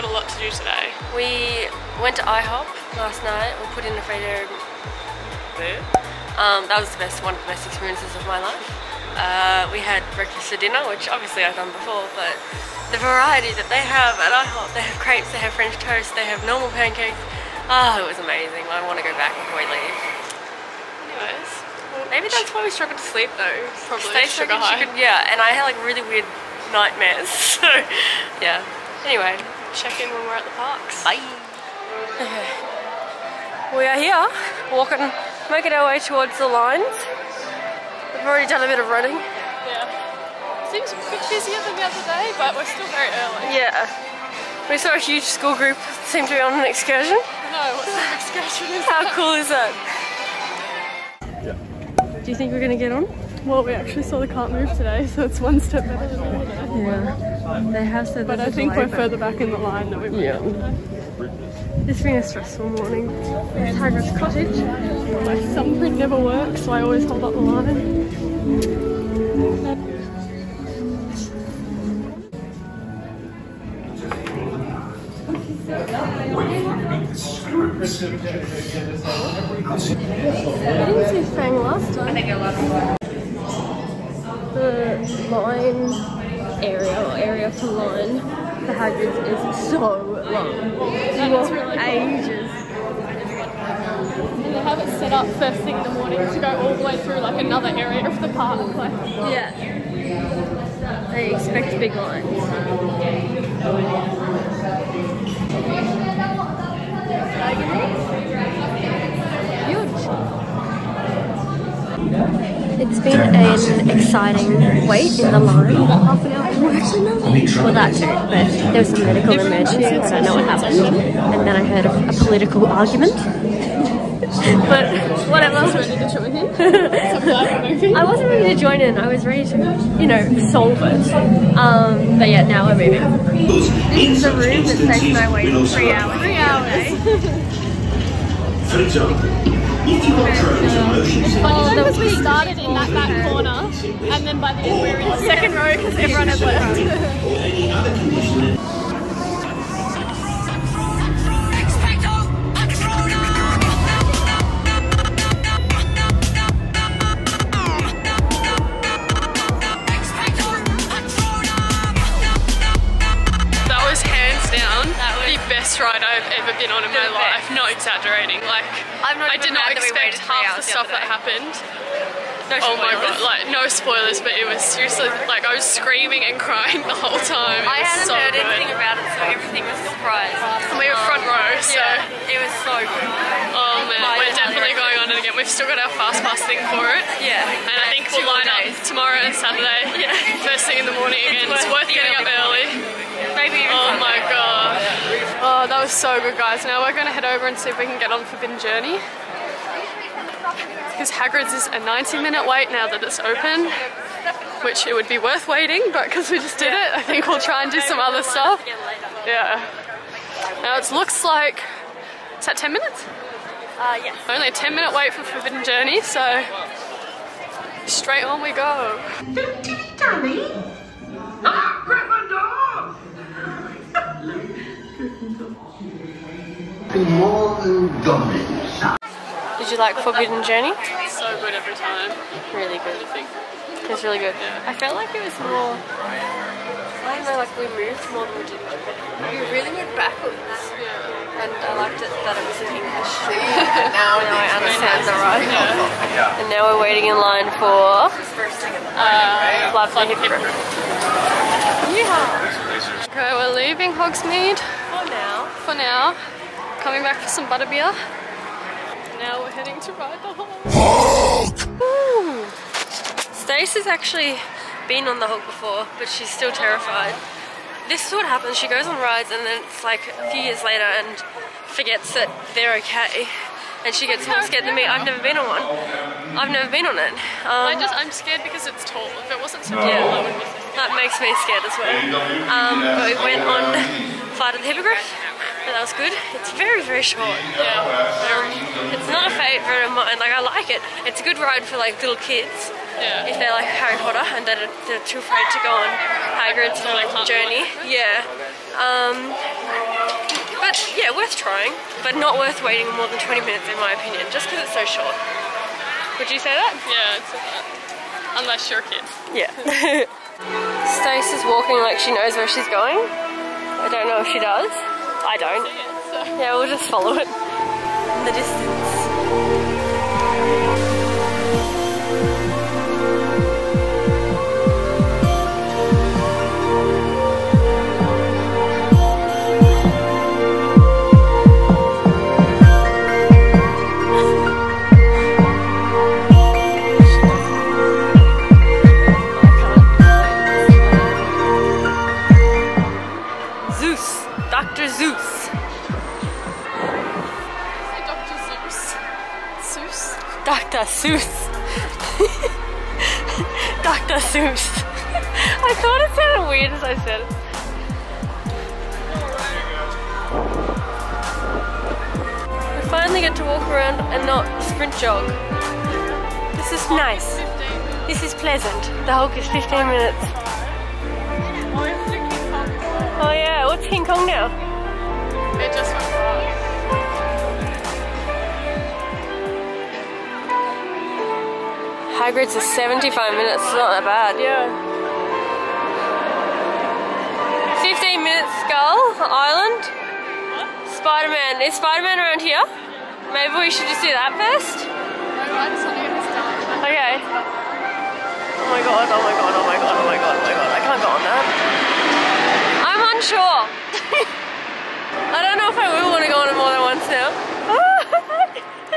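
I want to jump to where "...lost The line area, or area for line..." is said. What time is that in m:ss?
1:22.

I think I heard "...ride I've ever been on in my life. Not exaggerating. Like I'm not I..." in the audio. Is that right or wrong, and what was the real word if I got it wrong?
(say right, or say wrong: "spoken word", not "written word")
right.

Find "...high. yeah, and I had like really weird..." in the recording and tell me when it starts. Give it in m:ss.
0:24.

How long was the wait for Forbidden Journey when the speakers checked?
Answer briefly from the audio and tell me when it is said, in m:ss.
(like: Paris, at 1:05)
10 minutes, at 3:34.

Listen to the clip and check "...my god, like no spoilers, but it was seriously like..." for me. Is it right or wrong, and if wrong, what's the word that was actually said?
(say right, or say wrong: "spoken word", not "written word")
right.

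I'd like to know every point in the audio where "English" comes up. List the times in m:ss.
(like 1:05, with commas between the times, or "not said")
4:02.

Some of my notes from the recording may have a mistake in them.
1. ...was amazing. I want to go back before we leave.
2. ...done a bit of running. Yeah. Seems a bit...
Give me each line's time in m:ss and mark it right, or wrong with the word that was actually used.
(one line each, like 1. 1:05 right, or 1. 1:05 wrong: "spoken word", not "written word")
1. 0:18 right
2. 0:38 right.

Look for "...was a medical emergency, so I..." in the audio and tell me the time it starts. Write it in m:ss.
1:58.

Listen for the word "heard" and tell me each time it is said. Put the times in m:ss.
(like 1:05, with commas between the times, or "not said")
2:01, 2:58.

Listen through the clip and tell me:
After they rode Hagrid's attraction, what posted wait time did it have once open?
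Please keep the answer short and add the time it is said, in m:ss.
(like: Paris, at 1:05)
90 minutes, at 3:21.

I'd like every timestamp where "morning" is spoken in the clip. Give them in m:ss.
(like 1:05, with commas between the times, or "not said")
1:02, 1:35, 3:11.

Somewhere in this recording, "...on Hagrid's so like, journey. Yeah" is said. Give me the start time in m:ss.
4:55.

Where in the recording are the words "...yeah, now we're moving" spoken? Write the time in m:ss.
2:12.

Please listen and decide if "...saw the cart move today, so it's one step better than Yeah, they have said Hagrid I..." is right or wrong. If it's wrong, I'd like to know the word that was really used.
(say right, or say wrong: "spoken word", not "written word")
wrong: "But", not "Hagrid".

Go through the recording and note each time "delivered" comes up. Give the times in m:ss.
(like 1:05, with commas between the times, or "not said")
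not said.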